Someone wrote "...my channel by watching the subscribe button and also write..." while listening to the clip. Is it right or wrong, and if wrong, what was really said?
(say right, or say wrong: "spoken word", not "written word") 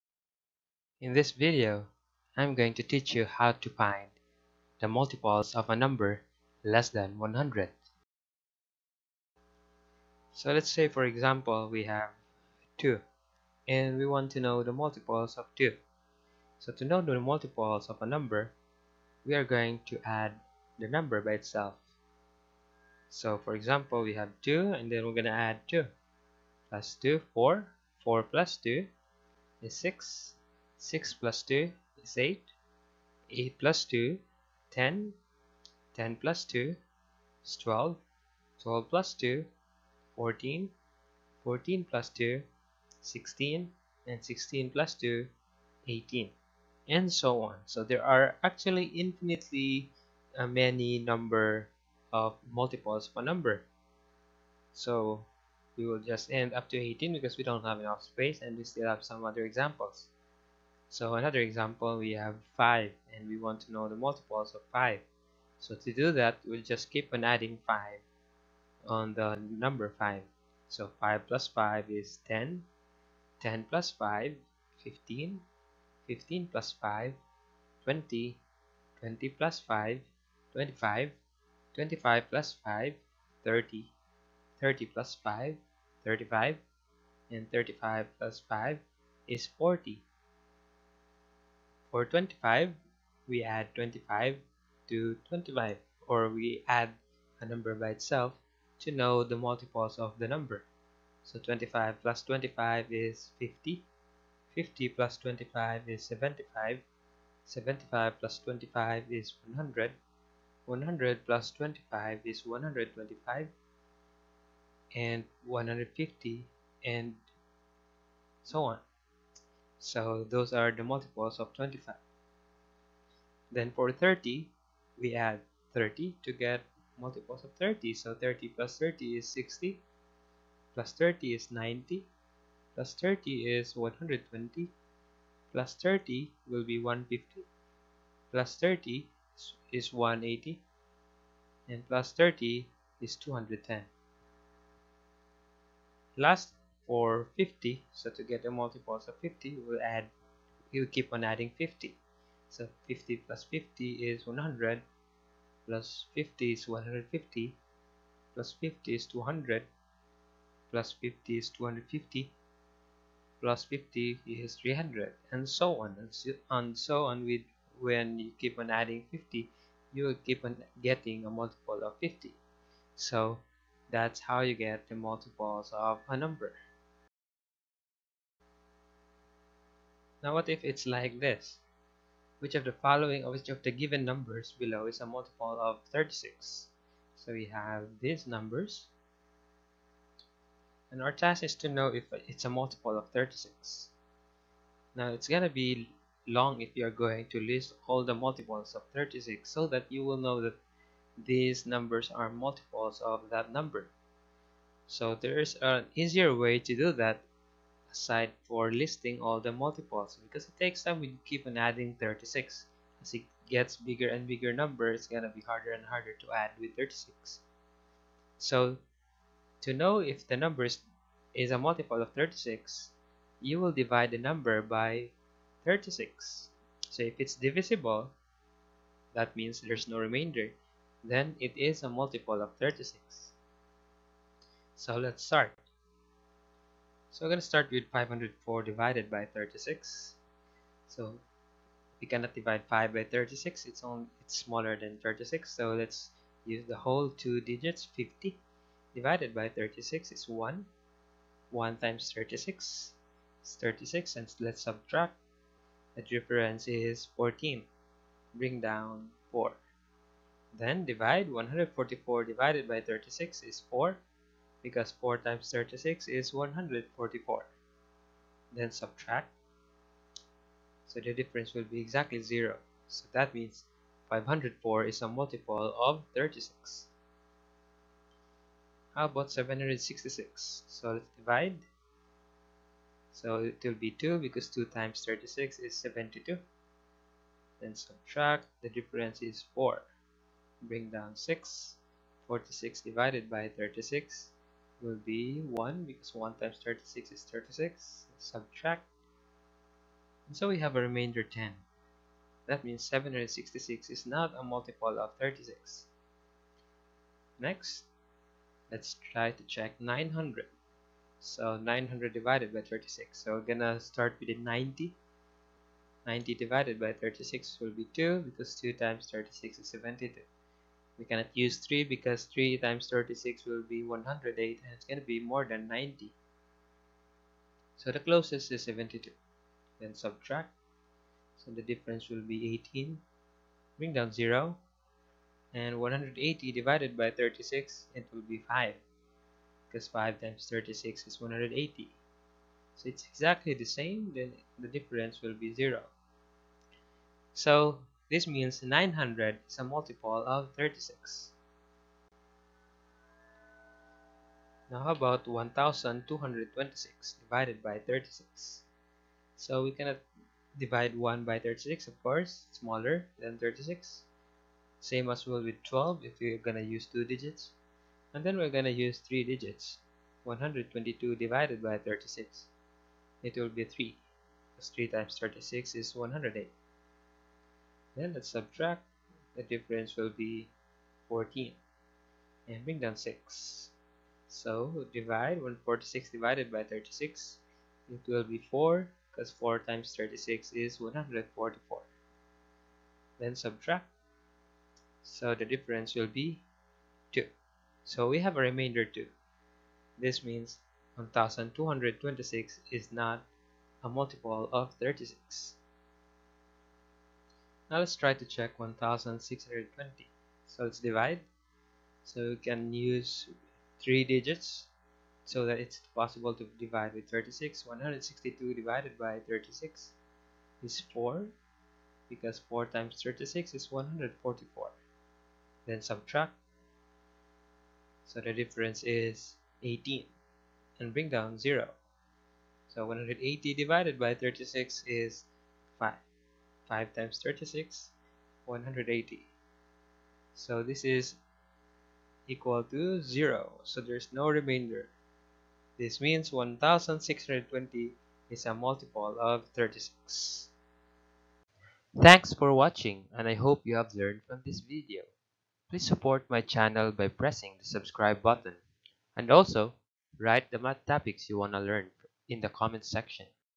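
wrong: "pressing", not "watching".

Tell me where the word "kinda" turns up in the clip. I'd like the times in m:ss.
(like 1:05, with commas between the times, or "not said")
not said.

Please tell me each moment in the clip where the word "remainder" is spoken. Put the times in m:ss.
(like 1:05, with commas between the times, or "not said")
3:49, 5:00, 6:38, 7:24.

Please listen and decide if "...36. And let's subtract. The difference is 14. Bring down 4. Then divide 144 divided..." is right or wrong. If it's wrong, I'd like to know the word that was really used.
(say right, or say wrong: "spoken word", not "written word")
right.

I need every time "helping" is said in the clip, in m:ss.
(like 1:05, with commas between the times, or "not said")
not said.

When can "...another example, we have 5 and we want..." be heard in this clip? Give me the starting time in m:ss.
1:01.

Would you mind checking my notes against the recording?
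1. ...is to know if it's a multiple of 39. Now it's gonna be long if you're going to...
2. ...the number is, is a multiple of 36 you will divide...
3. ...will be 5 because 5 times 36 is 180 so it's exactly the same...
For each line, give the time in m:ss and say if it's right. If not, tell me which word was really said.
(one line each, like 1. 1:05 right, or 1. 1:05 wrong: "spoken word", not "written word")
1. 3:11 wrong: "36", not "39"
2. 3:40 right
3. 5:38 right.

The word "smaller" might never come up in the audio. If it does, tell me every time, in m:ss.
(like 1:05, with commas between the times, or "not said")
4:04, 6:02.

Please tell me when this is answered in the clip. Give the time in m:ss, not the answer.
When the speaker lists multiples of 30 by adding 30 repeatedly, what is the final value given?
2:23.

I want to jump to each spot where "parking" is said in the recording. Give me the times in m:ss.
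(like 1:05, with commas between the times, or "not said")
not said.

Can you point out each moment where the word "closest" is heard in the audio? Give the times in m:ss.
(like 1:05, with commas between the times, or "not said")
5:28.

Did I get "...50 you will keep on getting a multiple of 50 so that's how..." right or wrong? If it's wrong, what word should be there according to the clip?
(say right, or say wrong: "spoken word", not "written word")
right.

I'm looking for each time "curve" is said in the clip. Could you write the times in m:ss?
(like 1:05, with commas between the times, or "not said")
not said.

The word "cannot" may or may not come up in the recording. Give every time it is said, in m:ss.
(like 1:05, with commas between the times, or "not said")
4:02, 5:21, 5:59.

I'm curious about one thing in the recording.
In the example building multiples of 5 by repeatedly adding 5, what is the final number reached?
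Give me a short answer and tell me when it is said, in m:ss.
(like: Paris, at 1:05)
40, at 1:29.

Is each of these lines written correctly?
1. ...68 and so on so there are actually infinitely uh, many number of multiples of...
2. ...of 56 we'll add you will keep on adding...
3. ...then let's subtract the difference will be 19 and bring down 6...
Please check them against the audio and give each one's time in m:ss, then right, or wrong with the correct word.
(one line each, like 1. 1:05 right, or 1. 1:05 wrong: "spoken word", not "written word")
1. 0:45 wrong: "18", not "68"
2. 2:29 wrong: "50", not "56"
3. 6:17 wrong: "14", not "19".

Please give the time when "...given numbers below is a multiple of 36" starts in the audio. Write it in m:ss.
3:03.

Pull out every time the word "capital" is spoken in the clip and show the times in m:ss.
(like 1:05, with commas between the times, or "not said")
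not said.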